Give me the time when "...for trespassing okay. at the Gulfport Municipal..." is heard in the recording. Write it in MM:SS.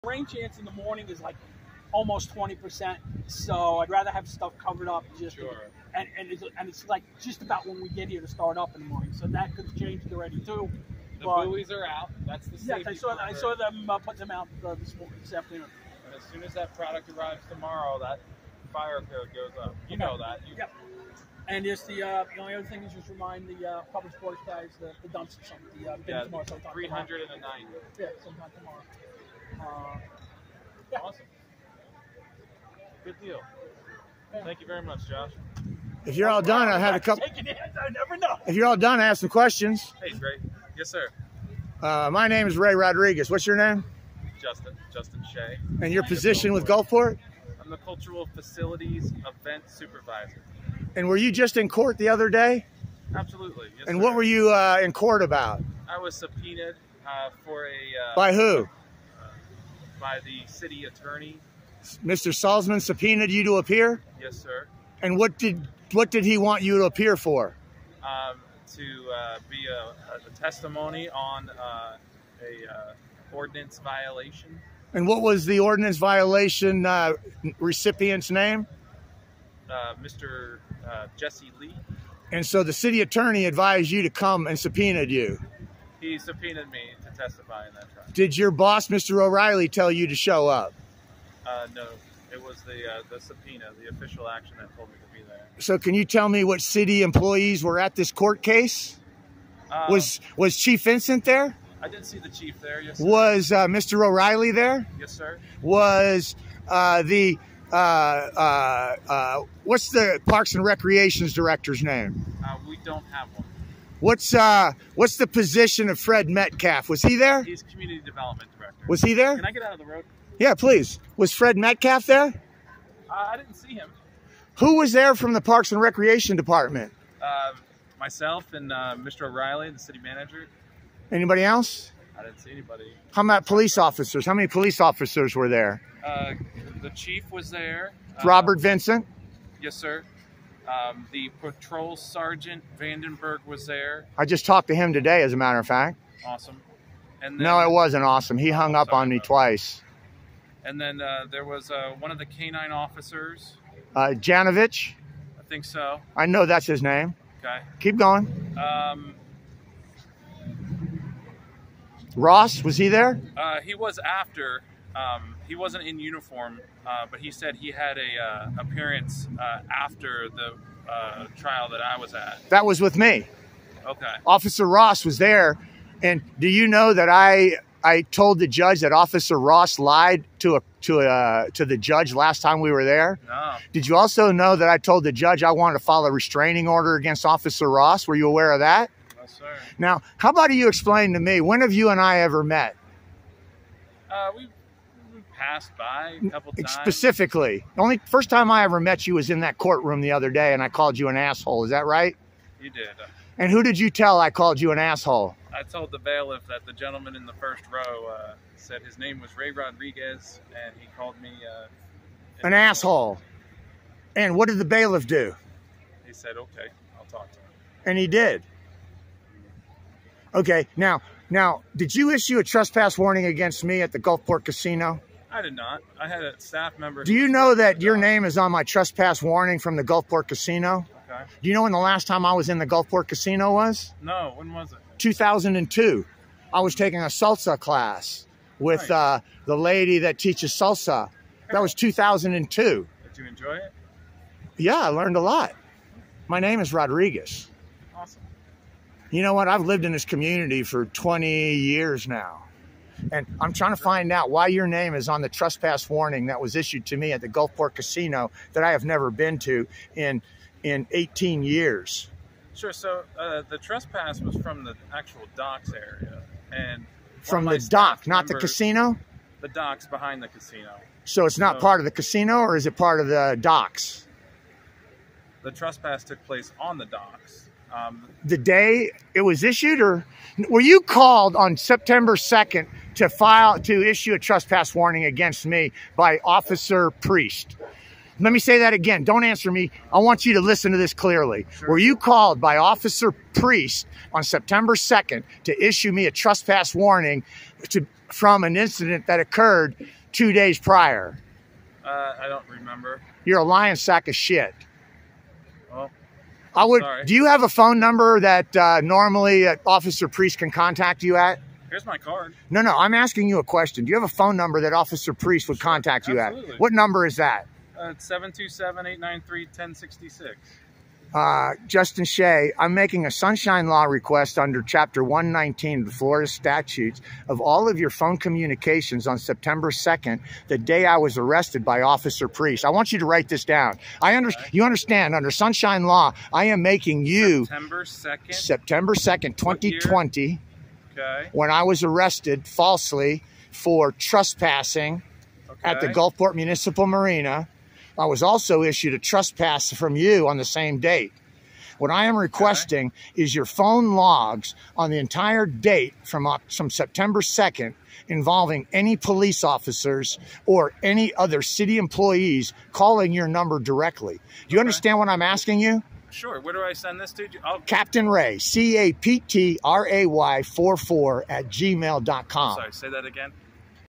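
05:43.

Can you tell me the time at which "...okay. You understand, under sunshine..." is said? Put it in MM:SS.
05:34.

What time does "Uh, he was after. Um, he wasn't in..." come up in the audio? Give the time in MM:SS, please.
02:43.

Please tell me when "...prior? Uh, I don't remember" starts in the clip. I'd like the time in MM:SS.
05:00.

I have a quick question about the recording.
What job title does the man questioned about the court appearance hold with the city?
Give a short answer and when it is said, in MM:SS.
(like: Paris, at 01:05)
Cultural Facilities Event Supervisor, at 00:47.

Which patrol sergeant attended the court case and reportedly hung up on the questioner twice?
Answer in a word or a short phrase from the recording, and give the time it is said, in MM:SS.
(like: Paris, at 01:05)
Vandenberg, at 02:22.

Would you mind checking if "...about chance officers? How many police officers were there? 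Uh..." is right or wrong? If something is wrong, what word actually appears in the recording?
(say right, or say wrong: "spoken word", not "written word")
wrong: "police", not "chance".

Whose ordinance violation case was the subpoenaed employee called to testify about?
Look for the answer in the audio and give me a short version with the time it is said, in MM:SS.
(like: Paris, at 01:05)
Jesse Lee, at 01:21.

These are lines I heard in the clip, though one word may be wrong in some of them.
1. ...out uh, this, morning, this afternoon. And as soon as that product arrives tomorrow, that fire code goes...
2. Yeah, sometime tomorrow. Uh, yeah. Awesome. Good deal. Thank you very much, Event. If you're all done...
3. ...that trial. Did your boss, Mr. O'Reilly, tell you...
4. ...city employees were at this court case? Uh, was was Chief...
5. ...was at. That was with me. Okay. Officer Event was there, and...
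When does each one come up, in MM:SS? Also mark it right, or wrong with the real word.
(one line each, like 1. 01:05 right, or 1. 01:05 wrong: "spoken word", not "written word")
1. 00:14 right
2. 00:27 wrong: "Josh", not "Event"
3. 01:27 right
4. 01:36 right
5. 02:51 wrong: "Ross", not "Event".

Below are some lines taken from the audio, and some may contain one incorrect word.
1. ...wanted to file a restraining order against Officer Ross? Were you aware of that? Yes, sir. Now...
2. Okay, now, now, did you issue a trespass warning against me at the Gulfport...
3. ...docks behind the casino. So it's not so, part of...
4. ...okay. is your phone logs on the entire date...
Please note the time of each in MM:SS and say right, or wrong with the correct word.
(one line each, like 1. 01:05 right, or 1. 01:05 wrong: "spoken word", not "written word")
1. 03:05 right
2. 03:40 right
3. 04:29 right
4. 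05:52 right.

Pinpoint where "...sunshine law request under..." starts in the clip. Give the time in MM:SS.
05:23.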